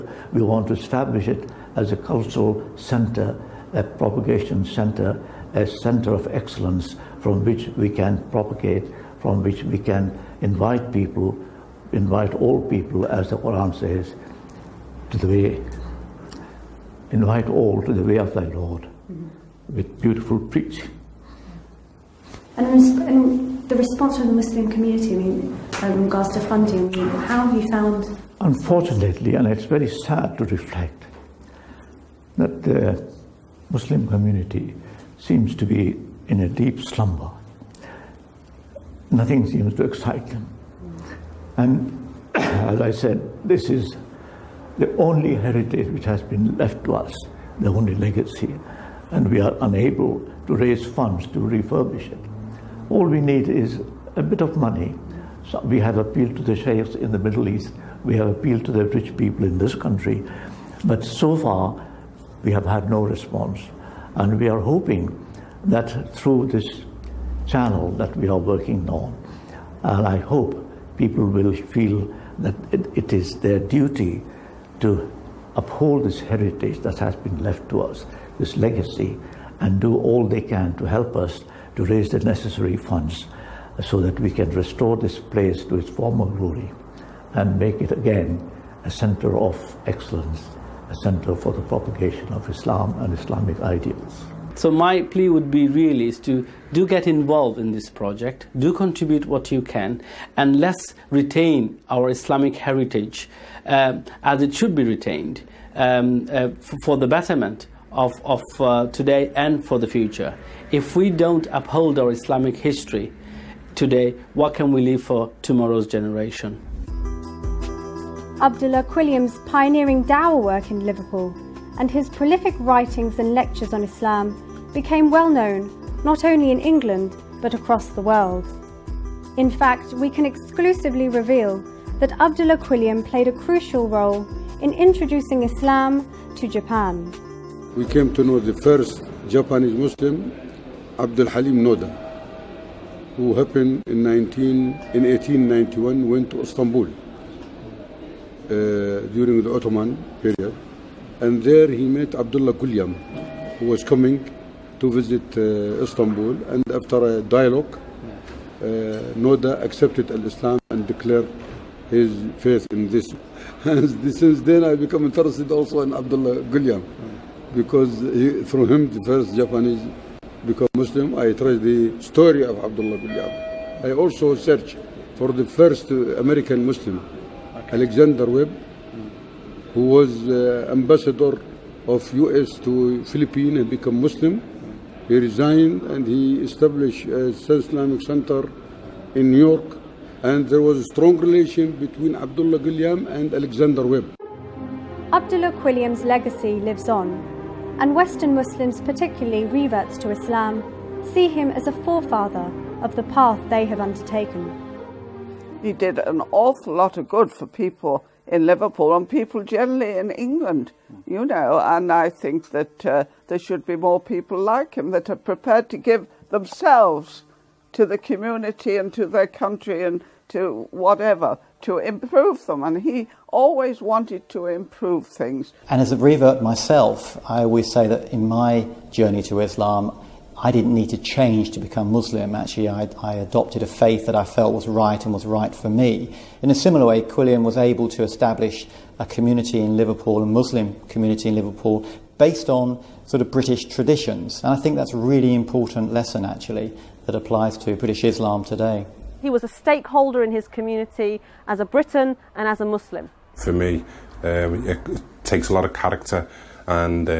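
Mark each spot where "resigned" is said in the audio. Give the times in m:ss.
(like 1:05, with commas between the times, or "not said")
3:05.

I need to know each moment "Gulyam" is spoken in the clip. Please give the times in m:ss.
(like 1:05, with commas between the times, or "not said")
2:32, 2:46.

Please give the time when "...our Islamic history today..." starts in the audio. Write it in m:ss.
1:51.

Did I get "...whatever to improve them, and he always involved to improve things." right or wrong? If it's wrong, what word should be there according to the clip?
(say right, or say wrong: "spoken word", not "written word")
wrong: "wanted", not "involved".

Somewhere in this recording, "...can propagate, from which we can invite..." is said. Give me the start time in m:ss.
0:07.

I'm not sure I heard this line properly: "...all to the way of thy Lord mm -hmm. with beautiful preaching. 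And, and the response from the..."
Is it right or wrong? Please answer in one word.
right.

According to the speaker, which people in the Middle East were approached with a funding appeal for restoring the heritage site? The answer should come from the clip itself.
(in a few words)
The sheikhs.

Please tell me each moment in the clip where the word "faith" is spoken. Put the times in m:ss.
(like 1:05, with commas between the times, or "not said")
2:42, 3:53.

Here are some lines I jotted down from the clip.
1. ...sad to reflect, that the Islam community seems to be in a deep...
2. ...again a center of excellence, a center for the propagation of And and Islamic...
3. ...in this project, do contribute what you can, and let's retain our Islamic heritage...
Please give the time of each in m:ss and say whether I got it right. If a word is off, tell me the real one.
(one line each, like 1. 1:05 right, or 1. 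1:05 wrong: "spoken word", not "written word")
1. 0:29 wrong: "Muslim", not "Islam"
2. 1:27 wrong: "Islam", not "And"
3. 1:37 right.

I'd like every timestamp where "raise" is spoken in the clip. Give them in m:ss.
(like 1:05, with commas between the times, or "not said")
0:50, 1:21.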